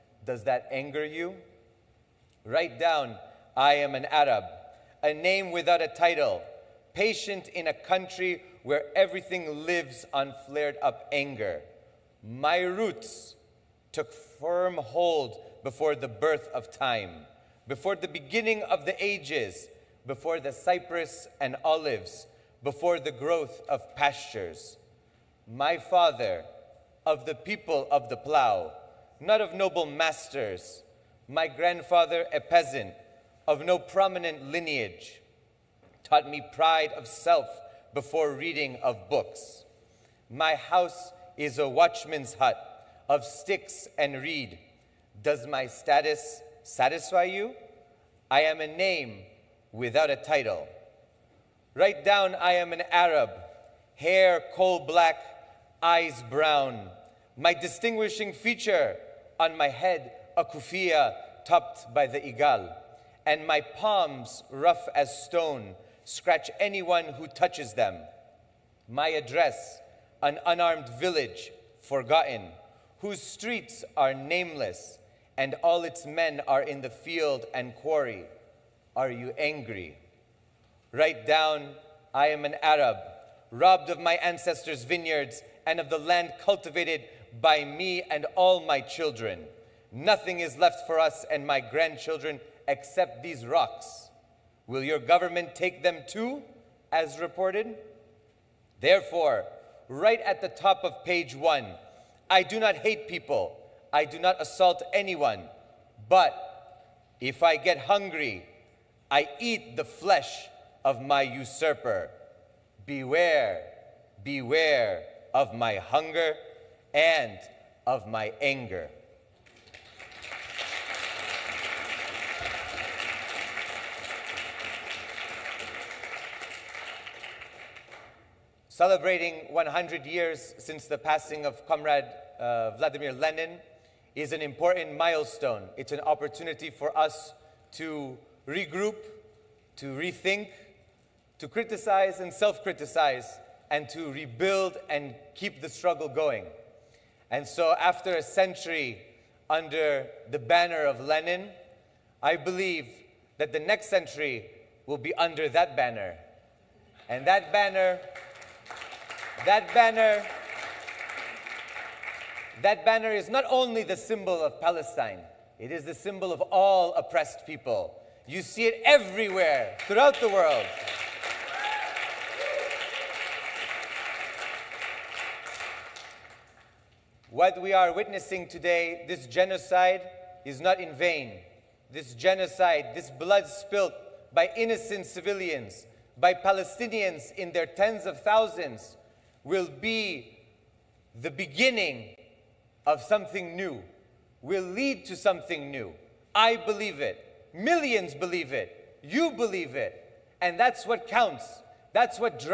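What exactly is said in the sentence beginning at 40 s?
My house is a watchman's hut, of sticks and reed.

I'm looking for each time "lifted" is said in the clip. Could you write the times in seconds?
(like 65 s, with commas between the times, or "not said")
not said.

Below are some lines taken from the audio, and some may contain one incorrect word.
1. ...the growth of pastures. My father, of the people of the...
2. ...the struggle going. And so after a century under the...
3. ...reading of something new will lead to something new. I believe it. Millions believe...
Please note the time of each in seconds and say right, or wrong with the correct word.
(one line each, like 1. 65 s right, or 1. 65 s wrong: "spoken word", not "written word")
1. 22 s right
2. 145 s right
3. 191 s wrong: "beginning", not "reading".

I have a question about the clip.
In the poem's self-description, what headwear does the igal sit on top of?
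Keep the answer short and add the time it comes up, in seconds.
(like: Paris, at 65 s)
Kufiya, at 60 s.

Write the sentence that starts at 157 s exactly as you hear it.
And that banner, that banner, that banner is not only the symbol of Palestine, it is the symbol of all oppressed people.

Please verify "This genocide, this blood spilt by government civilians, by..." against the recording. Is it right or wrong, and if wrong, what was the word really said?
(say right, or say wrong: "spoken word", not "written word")
wrong: "innocent", not "government".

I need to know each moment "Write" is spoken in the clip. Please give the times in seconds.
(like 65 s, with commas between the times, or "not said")
2 s, 51 s, 80 s.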